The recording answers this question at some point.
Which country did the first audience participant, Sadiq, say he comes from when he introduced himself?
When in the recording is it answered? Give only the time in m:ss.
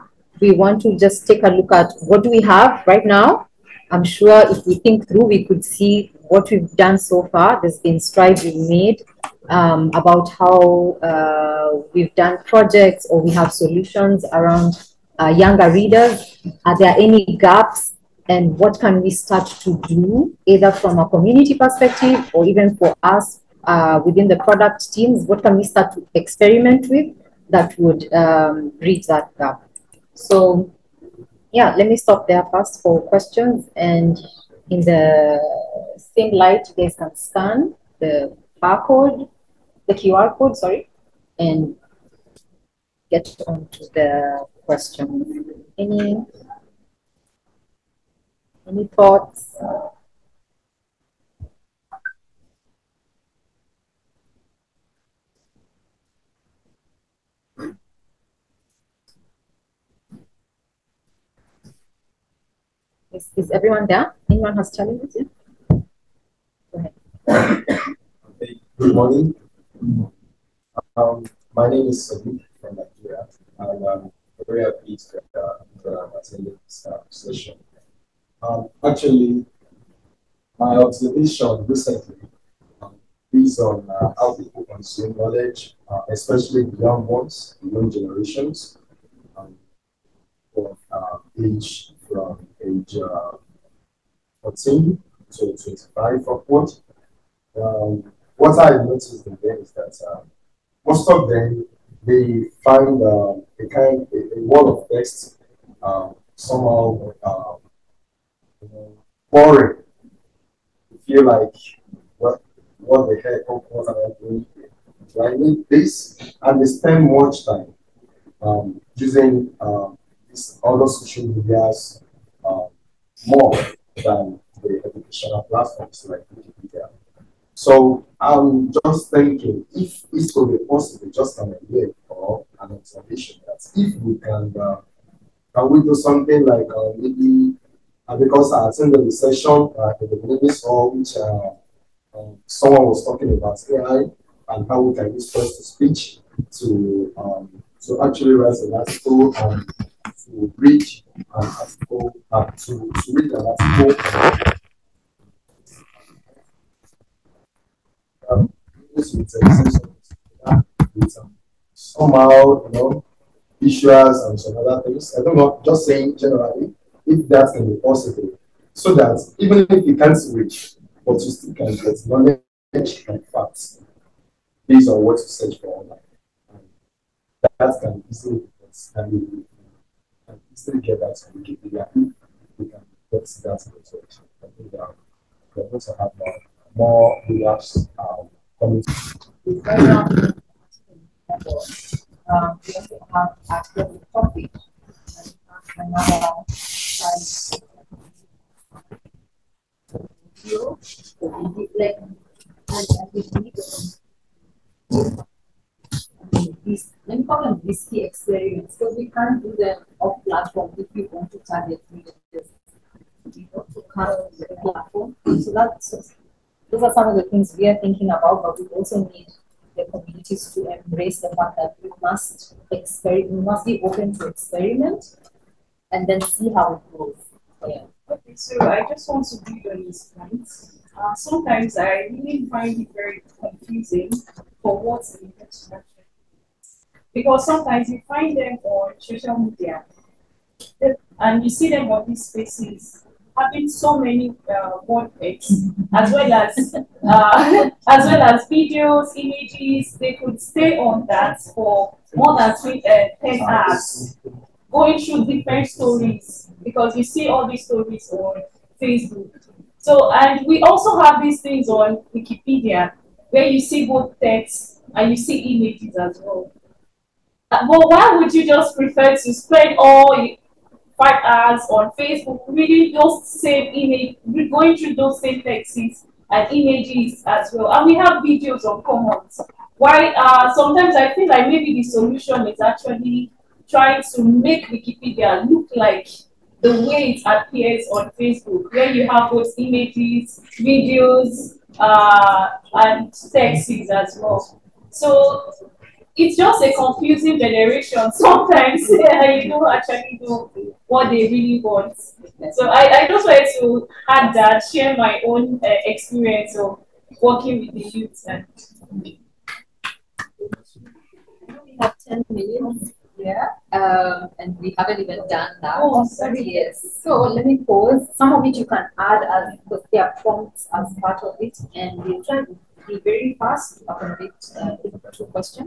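1:12.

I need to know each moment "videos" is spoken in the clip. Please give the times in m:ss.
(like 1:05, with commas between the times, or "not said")
4:08, 4:38, 4:50.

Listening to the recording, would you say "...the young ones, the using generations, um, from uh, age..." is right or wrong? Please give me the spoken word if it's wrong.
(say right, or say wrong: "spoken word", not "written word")
wrong: "young", not "using".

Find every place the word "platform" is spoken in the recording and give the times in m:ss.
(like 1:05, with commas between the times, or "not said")
2:05, 3:30, 3:34.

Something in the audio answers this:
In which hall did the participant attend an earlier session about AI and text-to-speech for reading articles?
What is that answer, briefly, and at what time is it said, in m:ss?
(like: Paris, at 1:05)
Benedict's Hall, at 2:20.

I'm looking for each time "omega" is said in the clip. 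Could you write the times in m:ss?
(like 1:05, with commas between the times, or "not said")
not said.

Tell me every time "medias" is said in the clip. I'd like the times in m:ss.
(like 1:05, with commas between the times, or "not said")
2:01, 3:59.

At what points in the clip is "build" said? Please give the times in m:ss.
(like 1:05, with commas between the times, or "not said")
3:49.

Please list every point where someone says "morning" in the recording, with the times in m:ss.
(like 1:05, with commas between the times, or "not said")
1:08.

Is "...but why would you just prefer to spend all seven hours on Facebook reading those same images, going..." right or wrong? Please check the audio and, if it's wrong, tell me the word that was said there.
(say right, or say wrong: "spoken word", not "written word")
wrong: "five", not "seven".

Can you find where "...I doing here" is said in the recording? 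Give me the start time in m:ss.
1:54.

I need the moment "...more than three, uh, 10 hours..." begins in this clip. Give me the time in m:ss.
4:12.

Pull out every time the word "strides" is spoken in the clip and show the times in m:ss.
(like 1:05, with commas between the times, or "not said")
0:07.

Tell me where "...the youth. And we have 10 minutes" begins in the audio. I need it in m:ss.
5:07.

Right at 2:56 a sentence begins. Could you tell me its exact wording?
And that can easily be understanding and easily get that to Wikipedia if we can get that result.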